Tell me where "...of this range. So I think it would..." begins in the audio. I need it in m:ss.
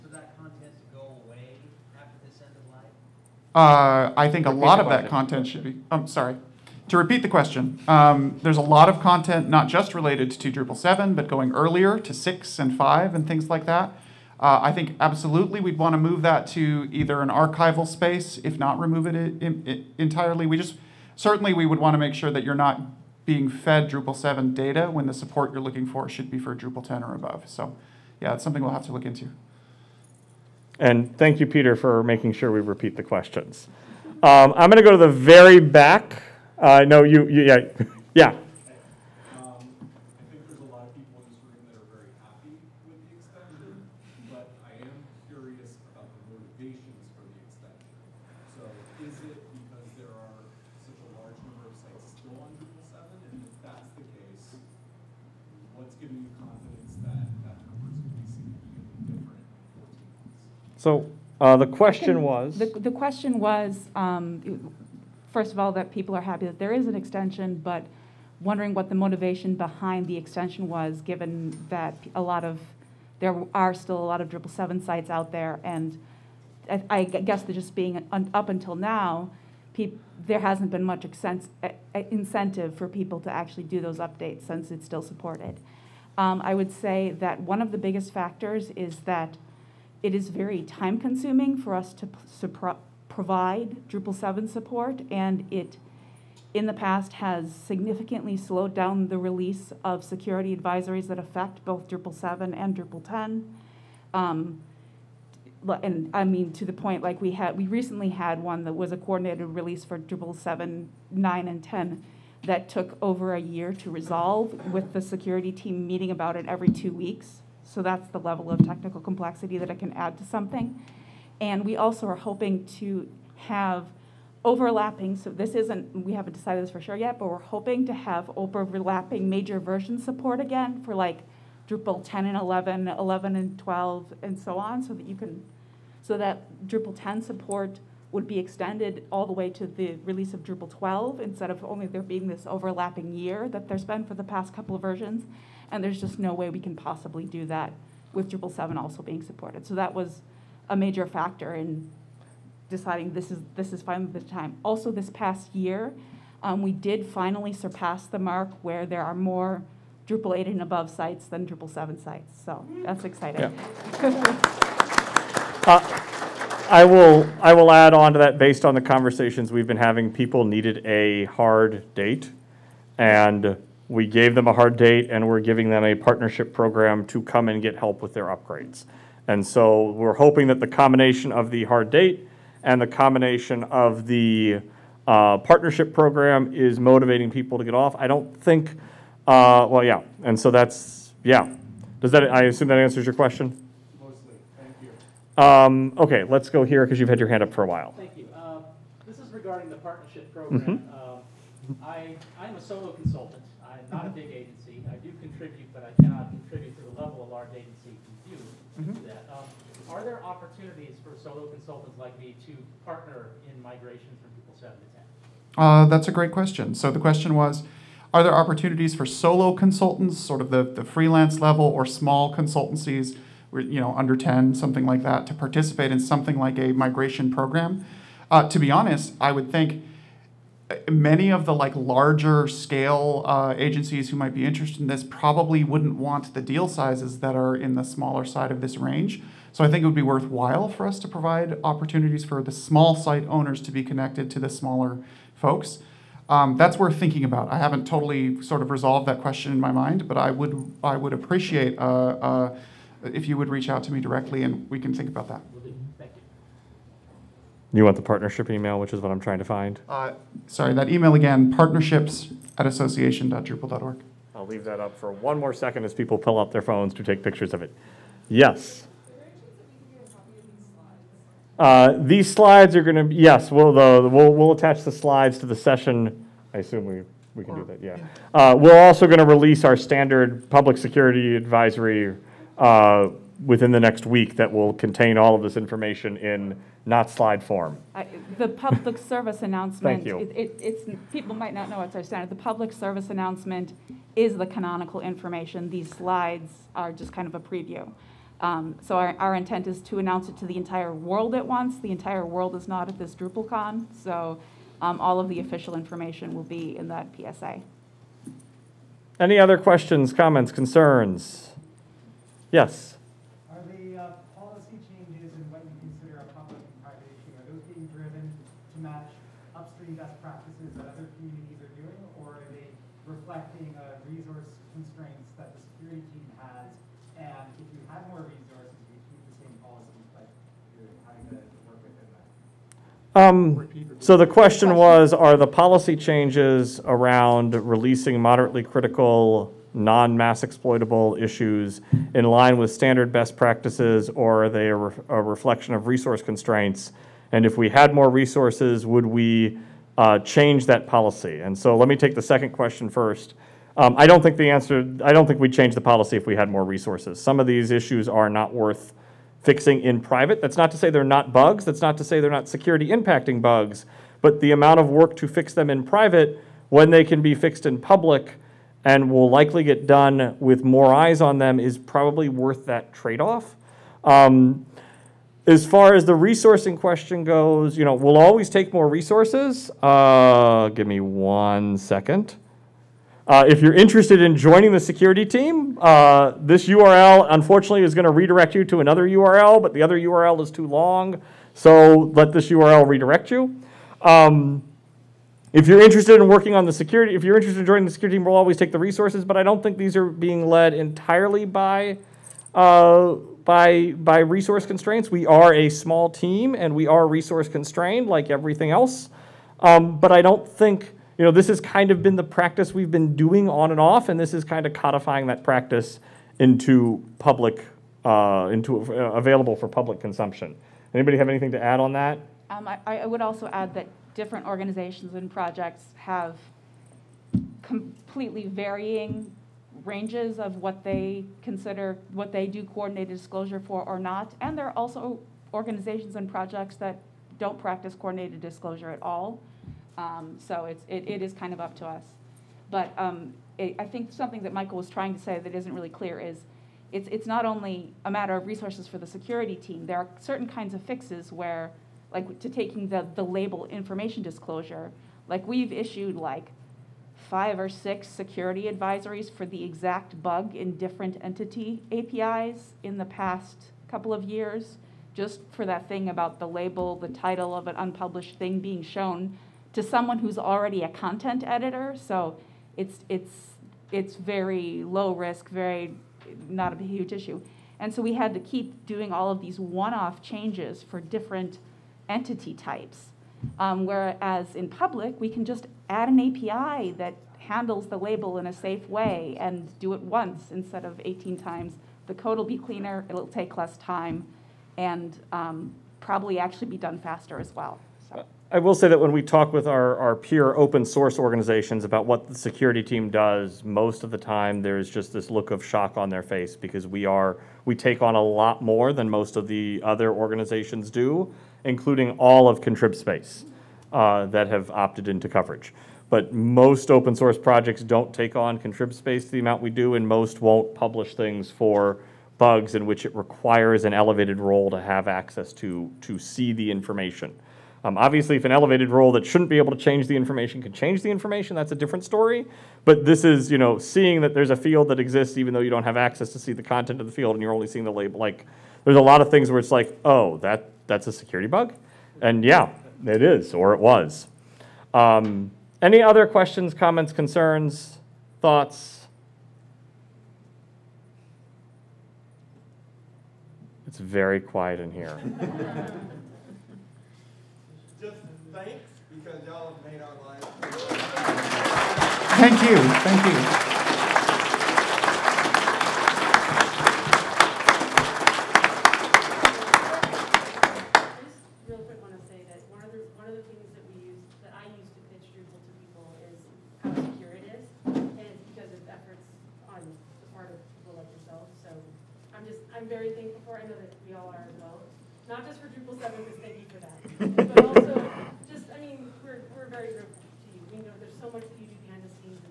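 3:58.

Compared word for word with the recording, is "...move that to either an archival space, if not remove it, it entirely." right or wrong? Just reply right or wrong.
right.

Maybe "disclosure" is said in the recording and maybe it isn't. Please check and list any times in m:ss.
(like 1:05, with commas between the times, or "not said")
7:13, 7:18, 7:34.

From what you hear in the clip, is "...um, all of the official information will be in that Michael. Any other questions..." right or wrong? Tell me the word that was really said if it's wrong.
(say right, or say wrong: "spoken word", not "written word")
wrong: "PSA", not "Michael".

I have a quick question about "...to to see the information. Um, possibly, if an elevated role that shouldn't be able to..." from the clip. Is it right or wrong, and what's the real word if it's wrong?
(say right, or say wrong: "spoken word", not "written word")
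wrong: "obviously", not "possibly".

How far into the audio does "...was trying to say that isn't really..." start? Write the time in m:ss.
7:24.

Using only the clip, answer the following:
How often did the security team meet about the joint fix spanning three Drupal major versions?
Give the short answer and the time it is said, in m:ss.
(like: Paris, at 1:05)
every two weeks, at 1:56.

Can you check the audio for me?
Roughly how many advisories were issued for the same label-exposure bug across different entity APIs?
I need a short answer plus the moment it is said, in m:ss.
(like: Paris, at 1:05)
5 or 6, at 7:37.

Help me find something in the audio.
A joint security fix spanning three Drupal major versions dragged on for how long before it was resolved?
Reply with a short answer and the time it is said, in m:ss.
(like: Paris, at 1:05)
over a year, at 1:53.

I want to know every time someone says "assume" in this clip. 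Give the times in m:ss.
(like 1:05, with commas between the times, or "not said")
3:12, 4:36.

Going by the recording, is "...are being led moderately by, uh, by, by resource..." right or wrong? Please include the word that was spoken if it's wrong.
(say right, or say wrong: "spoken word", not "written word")
wrong: "entirely", not "moderately".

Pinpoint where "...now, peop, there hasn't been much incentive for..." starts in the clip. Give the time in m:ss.
1:18.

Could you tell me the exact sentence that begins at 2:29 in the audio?
So that was a major factor in deciding this is this is finally the time.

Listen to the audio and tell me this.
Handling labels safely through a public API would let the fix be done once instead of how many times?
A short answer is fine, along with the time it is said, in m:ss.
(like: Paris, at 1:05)
18, at 8:11.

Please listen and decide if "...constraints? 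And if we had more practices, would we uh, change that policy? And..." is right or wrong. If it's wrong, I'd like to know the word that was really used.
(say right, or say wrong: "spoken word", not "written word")
wrong: "resources", not "practices".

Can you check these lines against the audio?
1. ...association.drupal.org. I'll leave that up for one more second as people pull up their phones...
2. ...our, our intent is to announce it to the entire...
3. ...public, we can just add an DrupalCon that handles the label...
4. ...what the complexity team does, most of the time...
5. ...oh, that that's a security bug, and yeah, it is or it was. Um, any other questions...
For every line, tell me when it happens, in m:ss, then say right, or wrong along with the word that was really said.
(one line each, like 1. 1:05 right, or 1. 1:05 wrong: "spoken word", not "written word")
1. 4:22 right
2. 4:58 right
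3. 8:04 wrong: "API", not "DrupalCon"
4. 8:22 wrong: "security", not "complexity"
5. 9:00 right.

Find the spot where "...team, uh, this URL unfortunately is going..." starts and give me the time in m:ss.
6:25.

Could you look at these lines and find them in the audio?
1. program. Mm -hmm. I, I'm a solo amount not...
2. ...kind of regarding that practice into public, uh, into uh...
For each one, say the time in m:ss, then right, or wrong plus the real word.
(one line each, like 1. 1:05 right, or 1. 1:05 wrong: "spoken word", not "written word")
1. 3:20 wrong: "consultant", not "amount"
2. 6:54 wrong: "codifying", not "regarding".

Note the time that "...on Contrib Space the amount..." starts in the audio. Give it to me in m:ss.
8:38.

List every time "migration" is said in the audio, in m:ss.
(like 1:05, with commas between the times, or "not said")
3:33, 3:46.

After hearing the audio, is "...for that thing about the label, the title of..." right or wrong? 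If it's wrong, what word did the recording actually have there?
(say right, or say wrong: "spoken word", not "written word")
right.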